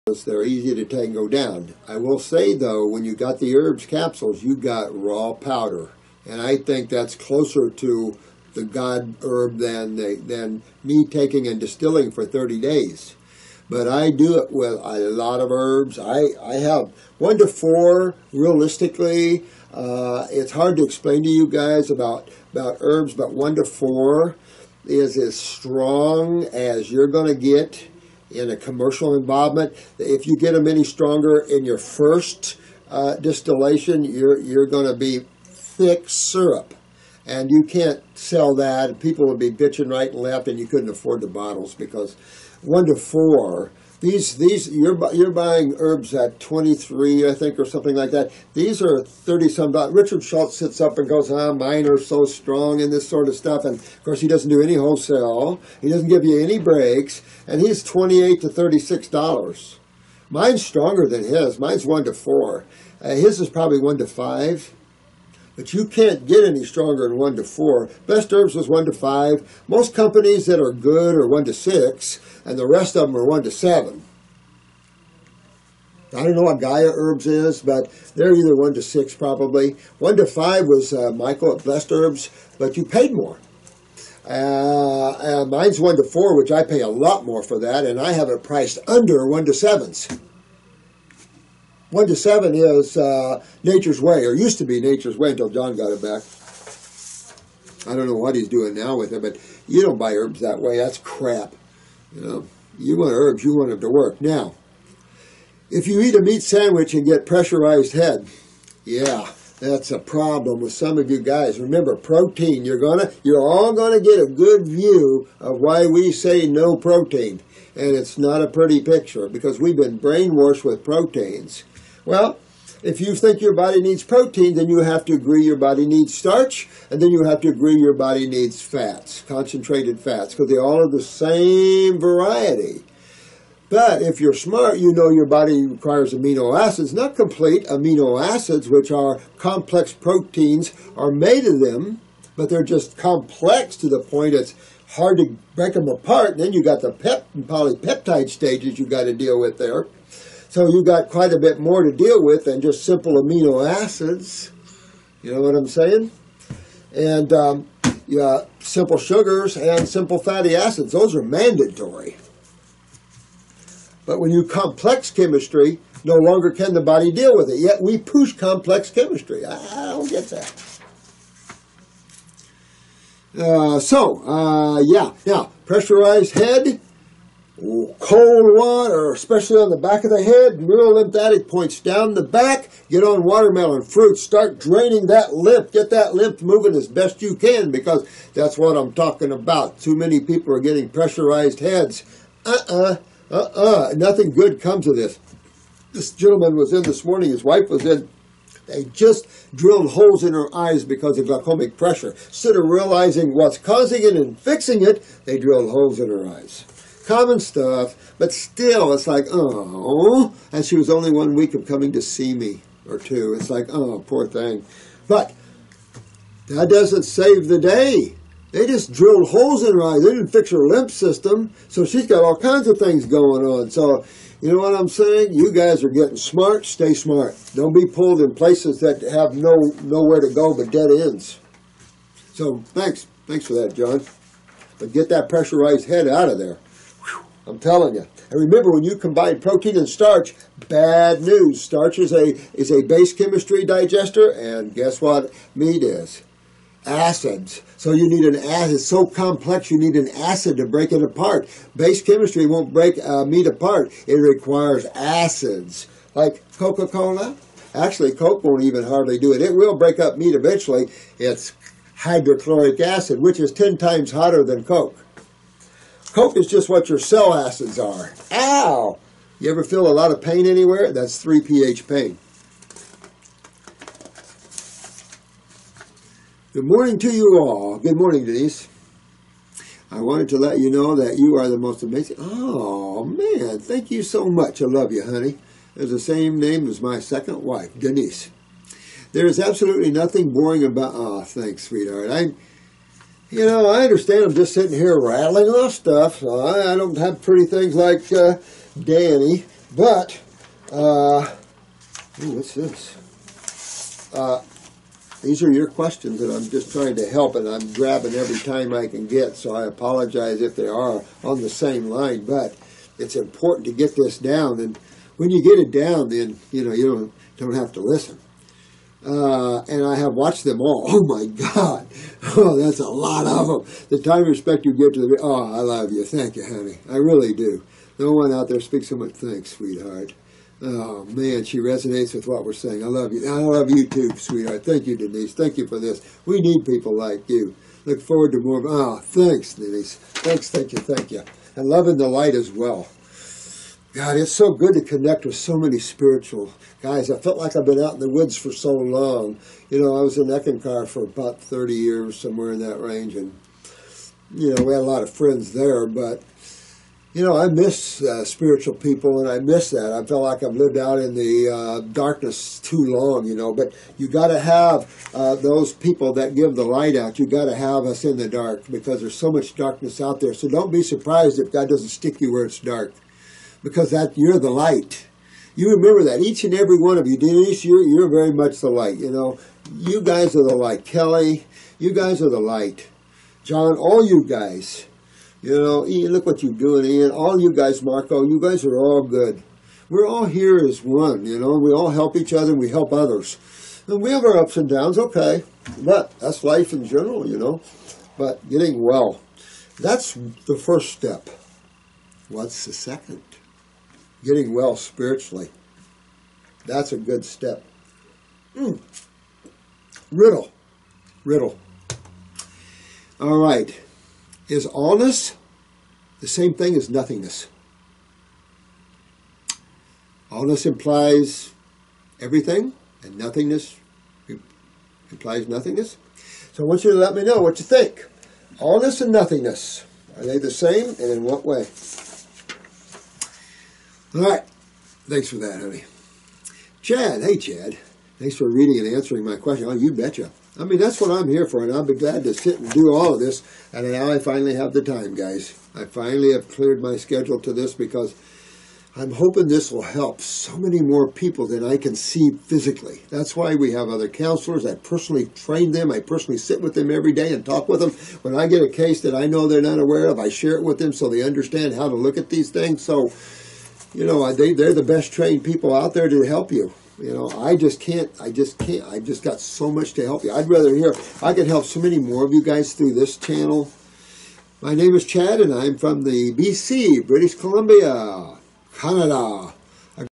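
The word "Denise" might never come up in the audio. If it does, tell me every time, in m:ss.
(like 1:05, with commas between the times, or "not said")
4:38, 4:47, 5:34, 5:39, 6:17.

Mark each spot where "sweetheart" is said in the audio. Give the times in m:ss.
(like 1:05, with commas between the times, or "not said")
4:51, 5:29, 5:34.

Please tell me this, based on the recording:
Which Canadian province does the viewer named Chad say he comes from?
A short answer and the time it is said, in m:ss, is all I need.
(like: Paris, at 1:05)
British Columbia, at 7:57.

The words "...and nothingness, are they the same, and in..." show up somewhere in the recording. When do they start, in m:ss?
7:09.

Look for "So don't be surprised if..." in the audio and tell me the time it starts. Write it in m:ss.
6:10.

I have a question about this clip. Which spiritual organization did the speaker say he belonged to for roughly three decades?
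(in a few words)
Eckankar.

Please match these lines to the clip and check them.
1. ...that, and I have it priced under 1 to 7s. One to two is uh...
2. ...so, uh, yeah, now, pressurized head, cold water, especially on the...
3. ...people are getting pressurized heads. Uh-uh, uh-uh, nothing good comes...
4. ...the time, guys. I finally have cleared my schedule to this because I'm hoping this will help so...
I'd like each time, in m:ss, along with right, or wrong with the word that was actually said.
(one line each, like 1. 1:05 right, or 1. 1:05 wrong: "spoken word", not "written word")
1. 1:27 wrong: "seven", not "two"
2. 2:53 right
3. 3:10 right
4. 7:24 right.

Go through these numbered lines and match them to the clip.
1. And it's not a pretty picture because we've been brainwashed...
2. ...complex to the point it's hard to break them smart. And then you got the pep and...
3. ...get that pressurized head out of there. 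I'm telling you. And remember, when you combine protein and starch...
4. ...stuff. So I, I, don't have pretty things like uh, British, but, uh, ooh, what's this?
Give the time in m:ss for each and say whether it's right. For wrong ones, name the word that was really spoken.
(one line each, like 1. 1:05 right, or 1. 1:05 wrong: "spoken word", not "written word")
1. 1:57 right
2. 2:22 wrong: "apart", not "smart"
3. 3:54 right
4. 4:55 wrong: "Danny", not "British".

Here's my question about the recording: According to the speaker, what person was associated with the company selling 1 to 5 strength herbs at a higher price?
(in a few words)
Michael.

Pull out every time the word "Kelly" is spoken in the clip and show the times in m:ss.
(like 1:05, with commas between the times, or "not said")
6:20.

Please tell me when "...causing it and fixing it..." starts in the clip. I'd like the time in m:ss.
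3:23.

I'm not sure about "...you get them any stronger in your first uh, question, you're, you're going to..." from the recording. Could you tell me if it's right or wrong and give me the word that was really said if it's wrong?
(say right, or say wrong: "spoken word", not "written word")
wrong: "distillation", not "question".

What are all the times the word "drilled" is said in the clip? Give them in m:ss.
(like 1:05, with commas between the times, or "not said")
3:19, 3:25, 3:38.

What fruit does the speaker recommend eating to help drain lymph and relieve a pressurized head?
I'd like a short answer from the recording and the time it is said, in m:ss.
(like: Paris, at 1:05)
watermelon, at 3:03.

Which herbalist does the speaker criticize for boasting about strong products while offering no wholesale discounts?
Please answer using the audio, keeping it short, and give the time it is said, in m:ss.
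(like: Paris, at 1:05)
Richard Schulze, at 0:49.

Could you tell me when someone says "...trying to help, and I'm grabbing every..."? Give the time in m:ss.
5:06.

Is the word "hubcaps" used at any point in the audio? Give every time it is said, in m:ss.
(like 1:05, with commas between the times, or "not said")
not said.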